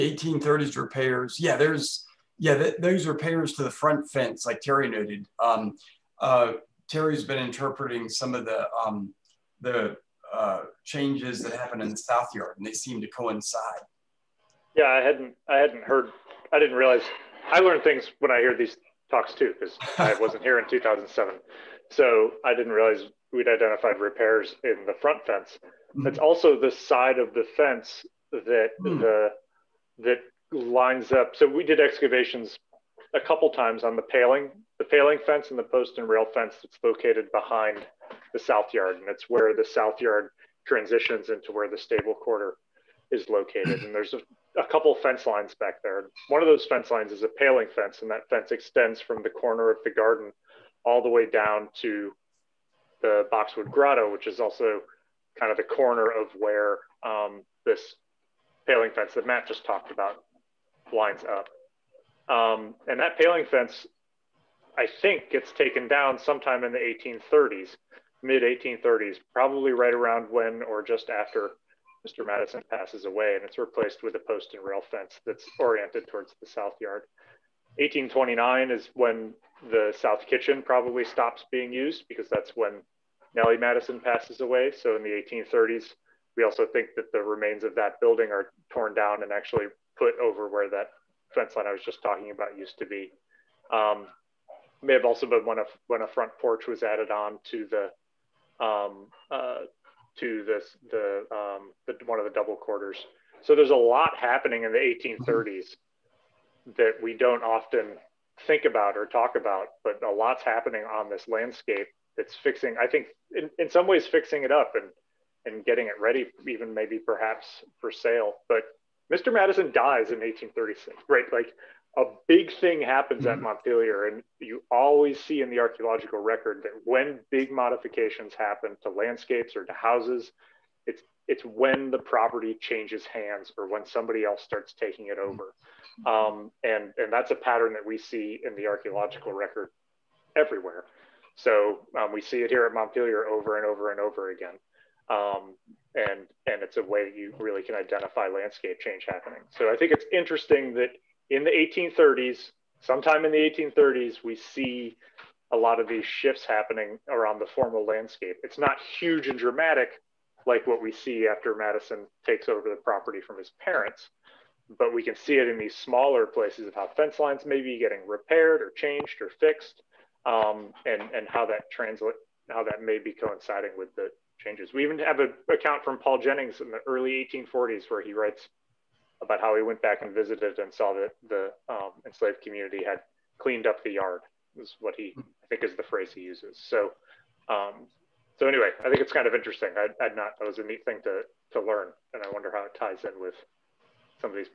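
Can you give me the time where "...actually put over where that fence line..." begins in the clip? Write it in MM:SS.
01:29.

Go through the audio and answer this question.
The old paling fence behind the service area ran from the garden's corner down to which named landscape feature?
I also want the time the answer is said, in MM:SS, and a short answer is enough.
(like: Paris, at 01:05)
Boxwood Grotto, at 00:53.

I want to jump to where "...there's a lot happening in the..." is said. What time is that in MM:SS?
01:43.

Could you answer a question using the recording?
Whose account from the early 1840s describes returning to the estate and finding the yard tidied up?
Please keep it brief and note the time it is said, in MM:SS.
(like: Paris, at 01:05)
Paul Jennings, at 02:55.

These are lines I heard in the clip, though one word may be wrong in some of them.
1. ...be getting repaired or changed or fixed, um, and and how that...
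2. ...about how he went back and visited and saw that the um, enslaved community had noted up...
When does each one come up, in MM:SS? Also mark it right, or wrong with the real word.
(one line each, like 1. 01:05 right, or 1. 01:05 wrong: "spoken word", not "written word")
1. 02:47 right
2. 02:59 wrong: "cleaned", not "noted".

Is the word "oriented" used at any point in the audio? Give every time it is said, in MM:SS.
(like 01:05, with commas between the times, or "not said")
01:15.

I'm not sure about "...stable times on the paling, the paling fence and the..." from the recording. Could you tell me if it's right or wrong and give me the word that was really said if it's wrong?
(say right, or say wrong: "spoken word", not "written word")
wrong: "couple", not "stable".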